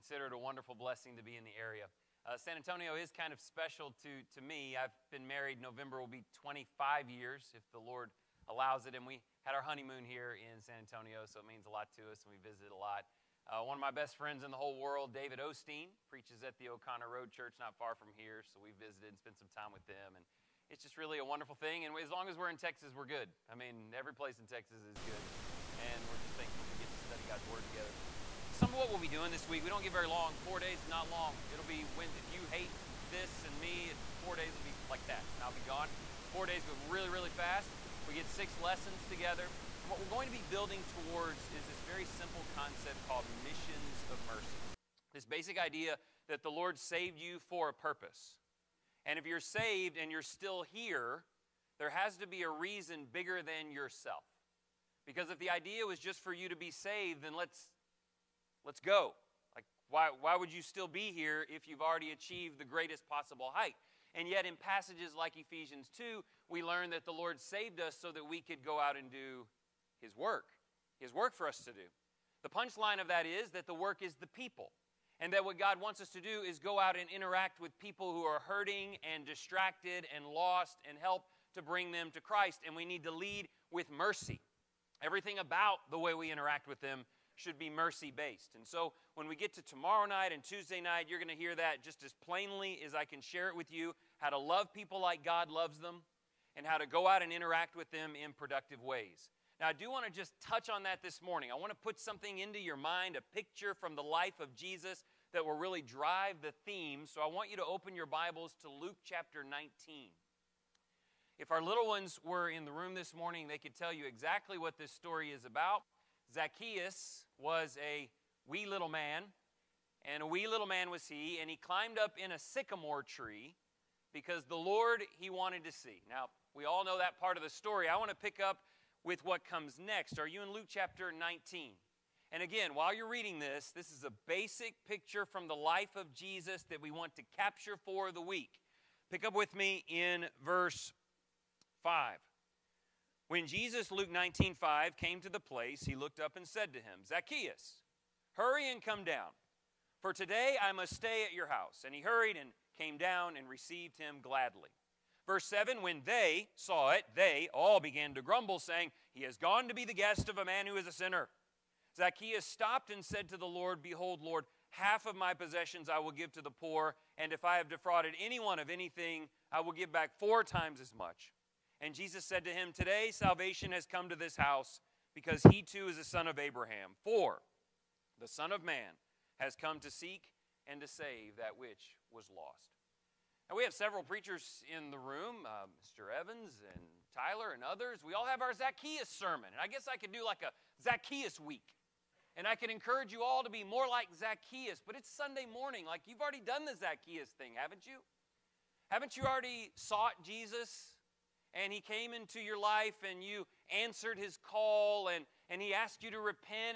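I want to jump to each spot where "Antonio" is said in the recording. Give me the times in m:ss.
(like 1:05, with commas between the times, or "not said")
0:02, 0:10.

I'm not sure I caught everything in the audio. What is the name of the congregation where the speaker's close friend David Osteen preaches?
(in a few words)
O'Connor Road Church.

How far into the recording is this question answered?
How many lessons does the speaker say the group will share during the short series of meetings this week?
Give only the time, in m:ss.
0:38.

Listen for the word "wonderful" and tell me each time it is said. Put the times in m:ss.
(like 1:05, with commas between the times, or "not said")
0:00, 0:21.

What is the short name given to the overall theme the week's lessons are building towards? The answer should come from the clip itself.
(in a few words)
missions of mercy.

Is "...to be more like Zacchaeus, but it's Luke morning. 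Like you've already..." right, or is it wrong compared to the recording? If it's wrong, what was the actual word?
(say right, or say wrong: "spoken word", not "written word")
wrong: "Sunday", not "Luke".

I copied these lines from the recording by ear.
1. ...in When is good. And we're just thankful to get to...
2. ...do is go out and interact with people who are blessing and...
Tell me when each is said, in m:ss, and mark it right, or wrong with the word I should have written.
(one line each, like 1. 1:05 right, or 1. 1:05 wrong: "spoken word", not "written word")
1. 0:24 wrong: "Texas", not "When"
2. 1:16 wrong: "hurting", not "blessing".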